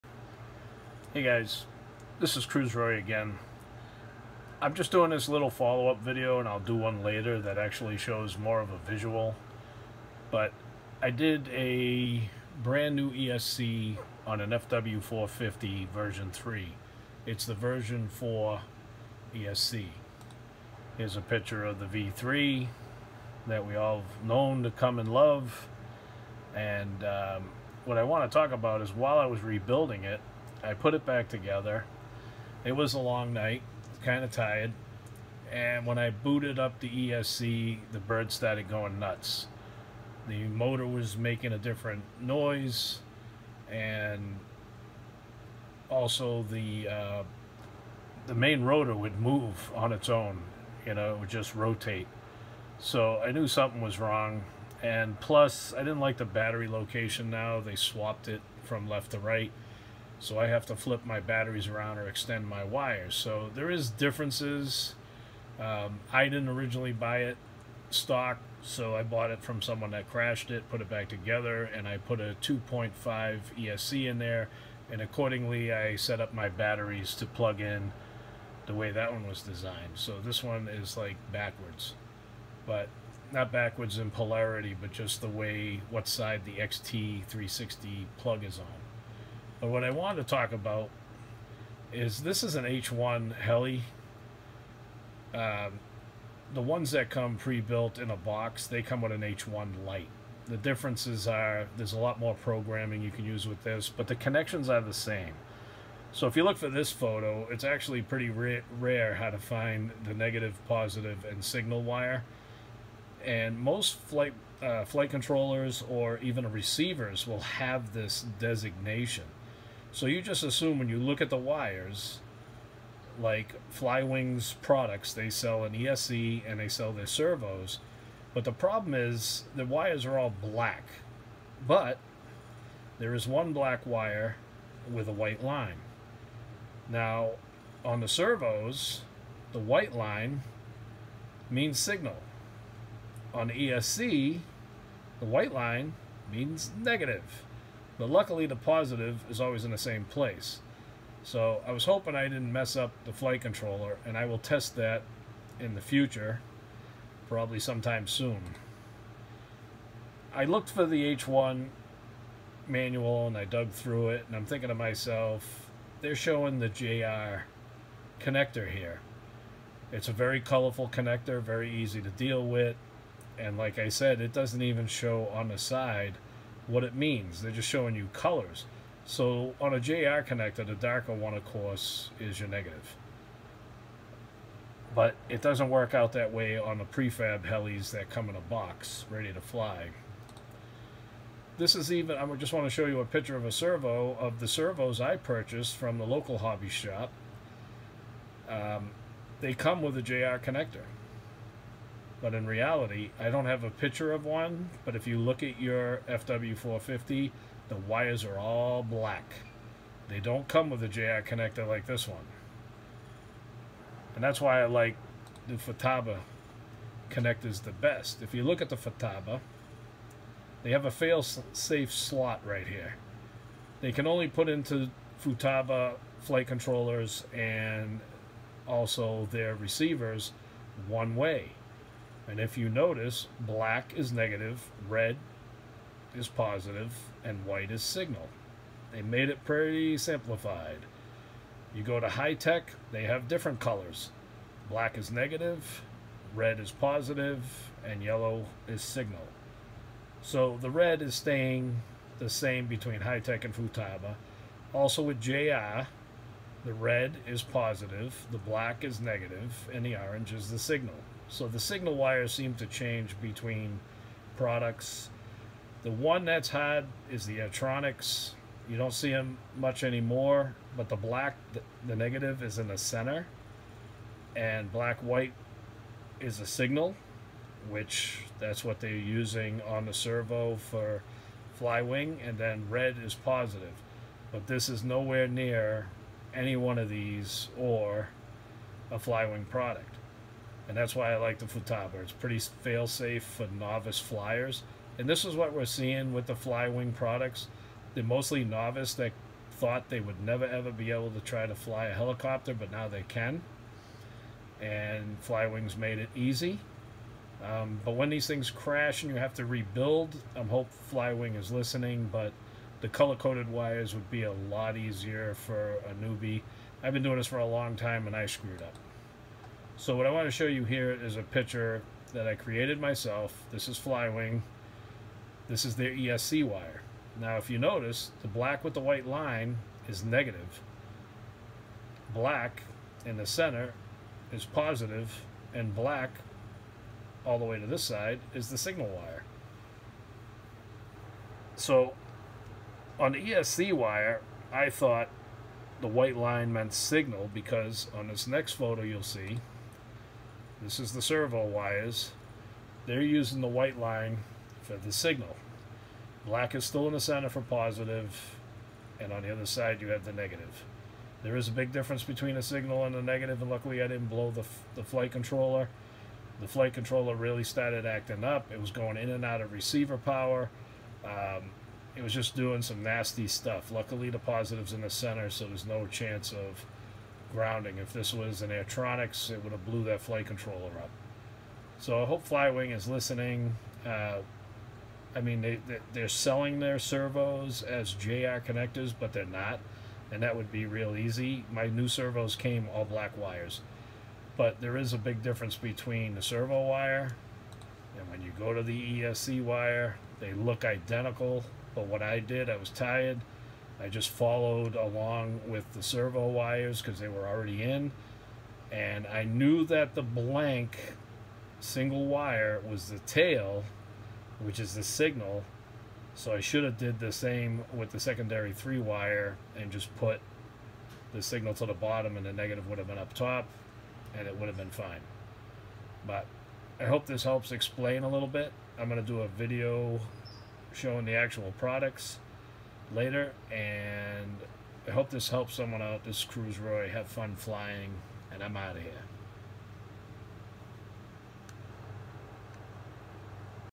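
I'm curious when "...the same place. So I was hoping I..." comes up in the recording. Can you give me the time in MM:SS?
02:29.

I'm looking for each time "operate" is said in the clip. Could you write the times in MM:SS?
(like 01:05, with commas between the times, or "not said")
not said.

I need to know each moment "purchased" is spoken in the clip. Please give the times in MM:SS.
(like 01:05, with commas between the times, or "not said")
03:15.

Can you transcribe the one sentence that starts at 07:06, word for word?
But I hope this helps explain a little bit.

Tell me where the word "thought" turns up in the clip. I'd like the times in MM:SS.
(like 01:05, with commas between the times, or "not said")
04:59, 05:44.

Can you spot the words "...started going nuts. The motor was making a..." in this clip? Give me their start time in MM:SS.
00:38.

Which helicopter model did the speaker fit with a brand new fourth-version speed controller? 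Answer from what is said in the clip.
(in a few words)
FW450 version 3.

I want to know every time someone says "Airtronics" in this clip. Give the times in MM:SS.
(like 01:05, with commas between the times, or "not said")
04:27, 06:18.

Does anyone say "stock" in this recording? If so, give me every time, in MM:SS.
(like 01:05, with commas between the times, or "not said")
01:07.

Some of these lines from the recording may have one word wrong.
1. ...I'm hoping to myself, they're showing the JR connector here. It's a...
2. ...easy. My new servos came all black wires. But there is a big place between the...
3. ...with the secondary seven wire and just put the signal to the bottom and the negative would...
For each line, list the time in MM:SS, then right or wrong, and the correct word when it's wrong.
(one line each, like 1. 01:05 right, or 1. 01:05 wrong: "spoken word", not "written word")
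1. 02:44 wrong: "thinking", not "hoping"
2. 06:30 wrong: "difference", not "place"
3. 06:57 wrong: "three", not "seven".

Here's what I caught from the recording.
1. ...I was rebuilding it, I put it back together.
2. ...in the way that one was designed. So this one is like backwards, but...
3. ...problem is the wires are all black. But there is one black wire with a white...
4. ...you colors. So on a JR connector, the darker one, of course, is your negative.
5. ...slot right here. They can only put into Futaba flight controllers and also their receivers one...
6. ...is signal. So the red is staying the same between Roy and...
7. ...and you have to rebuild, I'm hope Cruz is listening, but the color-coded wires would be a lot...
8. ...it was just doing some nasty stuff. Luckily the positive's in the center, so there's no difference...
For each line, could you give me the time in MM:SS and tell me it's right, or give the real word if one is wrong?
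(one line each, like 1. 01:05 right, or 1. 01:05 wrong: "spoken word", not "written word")
1. 00:29 right
2. 01:17 right
3. 02:08 right
4. 02:57 right
5. 03:41 right
6. 04:08 wrong: "Hitec", not "Roy"
7. 05:09 wrong: "Flywing", not "Cruz"
8. 06:11 wrong: "chance", not "difference".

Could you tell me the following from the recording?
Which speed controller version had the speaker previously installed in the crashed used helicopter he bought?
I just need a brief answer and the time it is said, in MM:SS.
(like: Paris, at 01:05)
2.5, at 01:12.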